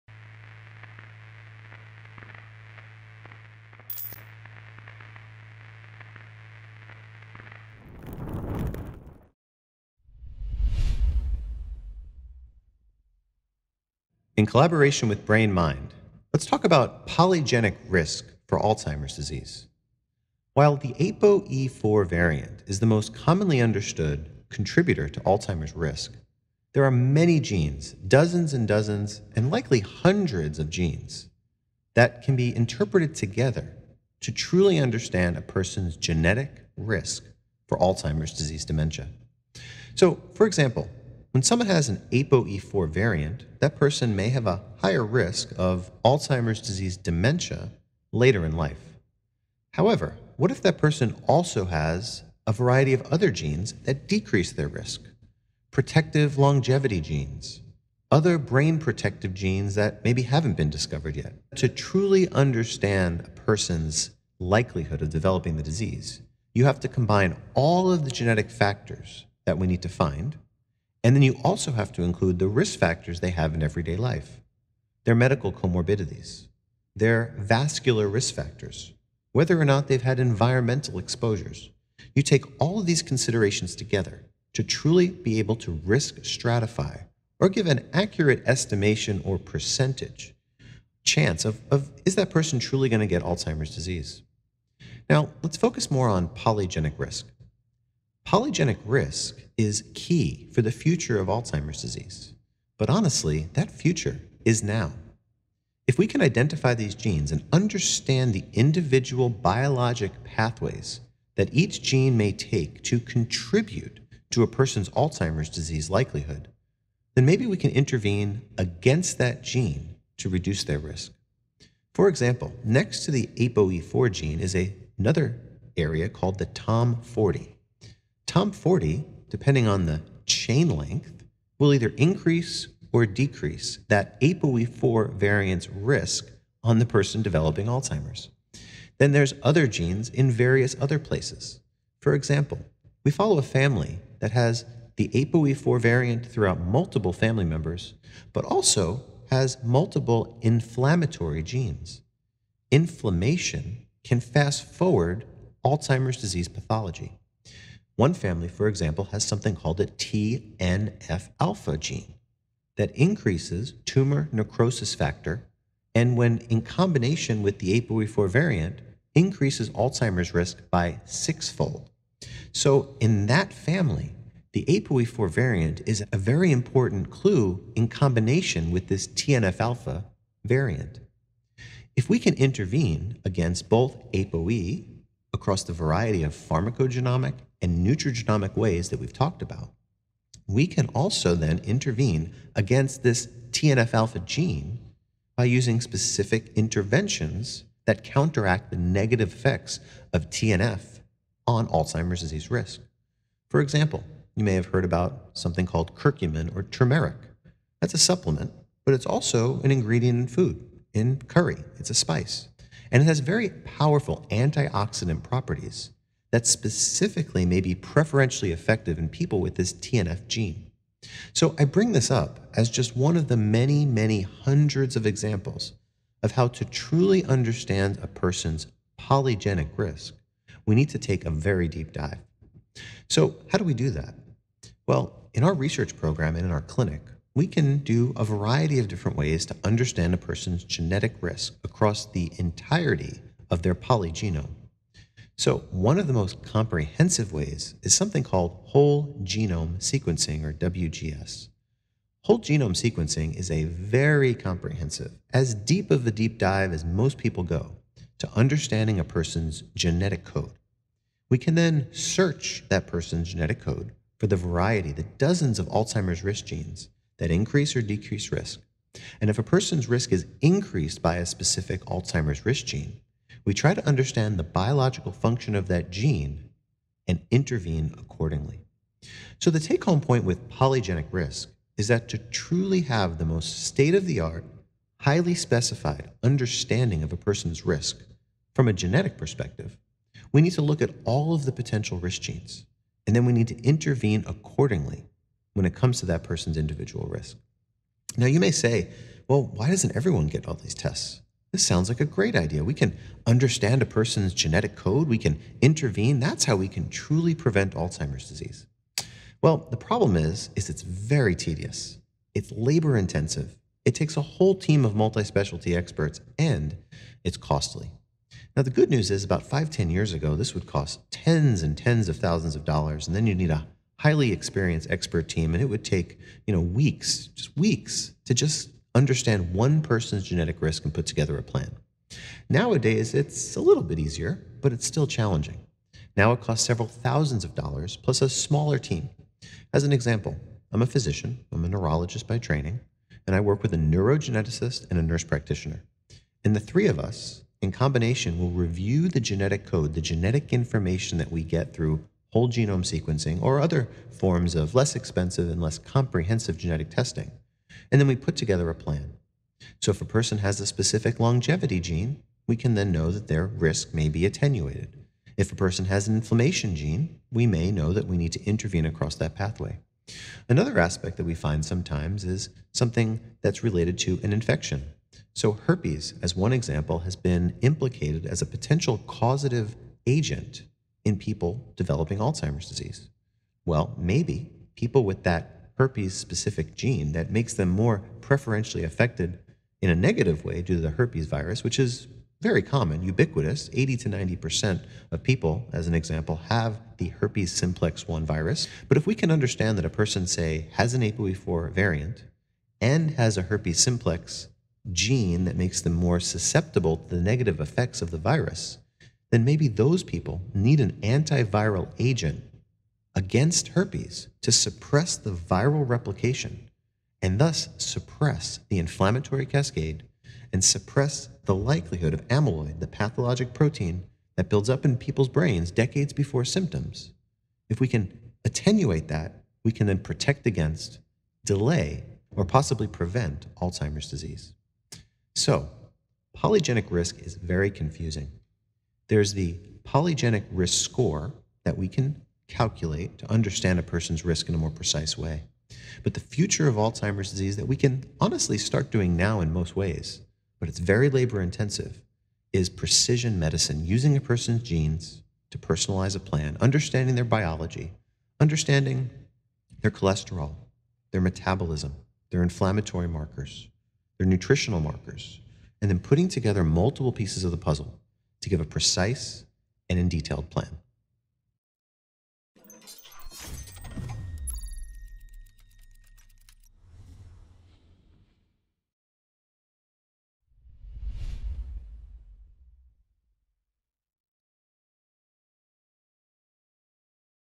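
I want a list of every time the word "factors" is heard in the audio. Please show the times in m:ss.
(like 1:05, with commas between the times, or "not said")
1:08, 1:12, 1:18, 2:44.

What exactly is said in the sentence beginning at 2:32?
Inflammation can fast forward Alzheimer's disease pathology.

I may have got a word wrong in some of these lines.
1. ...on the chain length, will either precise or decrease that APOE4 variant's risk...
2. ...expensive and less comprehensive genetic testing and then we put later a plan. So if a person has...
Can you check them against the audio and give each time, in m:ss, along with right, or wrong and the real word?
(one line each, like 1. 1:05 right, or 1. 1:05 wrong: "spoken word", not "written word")
1. 2:09 wrong: "increase", not "precise"
2. 5:54 wrong: "together", not "later".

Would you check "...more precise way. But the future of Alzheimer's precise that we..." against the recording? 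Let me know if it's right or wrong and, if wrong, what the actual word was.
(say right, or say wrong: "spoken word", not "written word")
wrong: "disease", not "precise".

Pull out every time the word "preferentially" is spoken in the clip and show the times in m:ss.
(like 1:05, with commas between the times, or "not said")
3:37, 6:28.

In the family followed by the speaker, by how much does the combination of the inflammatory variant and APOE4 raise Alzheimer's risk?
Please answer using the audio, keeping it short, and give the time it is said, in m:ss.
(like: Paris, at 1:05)
sixfold, at 2:51.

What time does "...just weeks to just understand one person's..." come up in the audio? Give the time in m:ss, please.
5:27.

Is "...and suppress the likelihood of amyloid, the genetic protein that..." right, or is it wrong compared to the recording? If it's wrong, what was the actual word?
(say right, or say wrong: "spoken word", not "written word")
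wrong: "pathologic", not "genetic".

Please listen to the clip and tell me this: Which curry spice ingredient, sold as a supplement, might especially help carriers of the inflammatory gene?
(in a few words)
curcumin or turmeric.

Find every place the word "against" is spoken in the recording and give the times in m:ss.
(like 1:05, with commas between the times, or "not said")
1:58, 3:03, 3:12, 6:53, 7:10.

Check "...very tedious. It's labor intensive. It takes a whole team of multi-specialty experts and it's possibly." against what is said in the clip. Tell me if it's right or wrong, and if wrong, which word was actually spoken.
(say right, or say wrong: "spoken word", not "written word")
wrong: "costly", not "possibly".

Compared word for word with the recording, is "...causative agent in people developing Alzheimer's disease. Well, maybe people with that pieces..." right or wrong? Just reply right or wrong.
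wrong.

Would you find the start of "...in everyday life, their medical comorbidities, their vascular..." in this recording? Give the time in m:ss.
1:13.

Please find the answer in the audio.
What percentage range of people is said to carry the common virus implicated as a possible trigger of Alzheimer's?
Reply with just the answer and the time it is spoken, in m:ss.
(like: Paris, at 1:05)
80 to 90%, at 6:33.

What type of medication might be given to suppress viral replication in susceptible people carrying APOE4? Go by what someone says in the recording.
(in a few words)
antiviral agent.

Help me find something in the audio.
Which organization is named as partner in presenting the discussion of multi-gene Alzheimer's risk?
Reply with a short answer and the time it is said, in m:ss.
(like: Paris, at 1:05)
BrainMind, at 0:15.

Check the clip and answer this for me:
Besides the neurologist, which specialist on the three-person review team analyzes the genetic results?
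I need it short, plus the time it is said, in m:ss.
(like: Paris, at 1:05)
neurogeneticist, at 5:43.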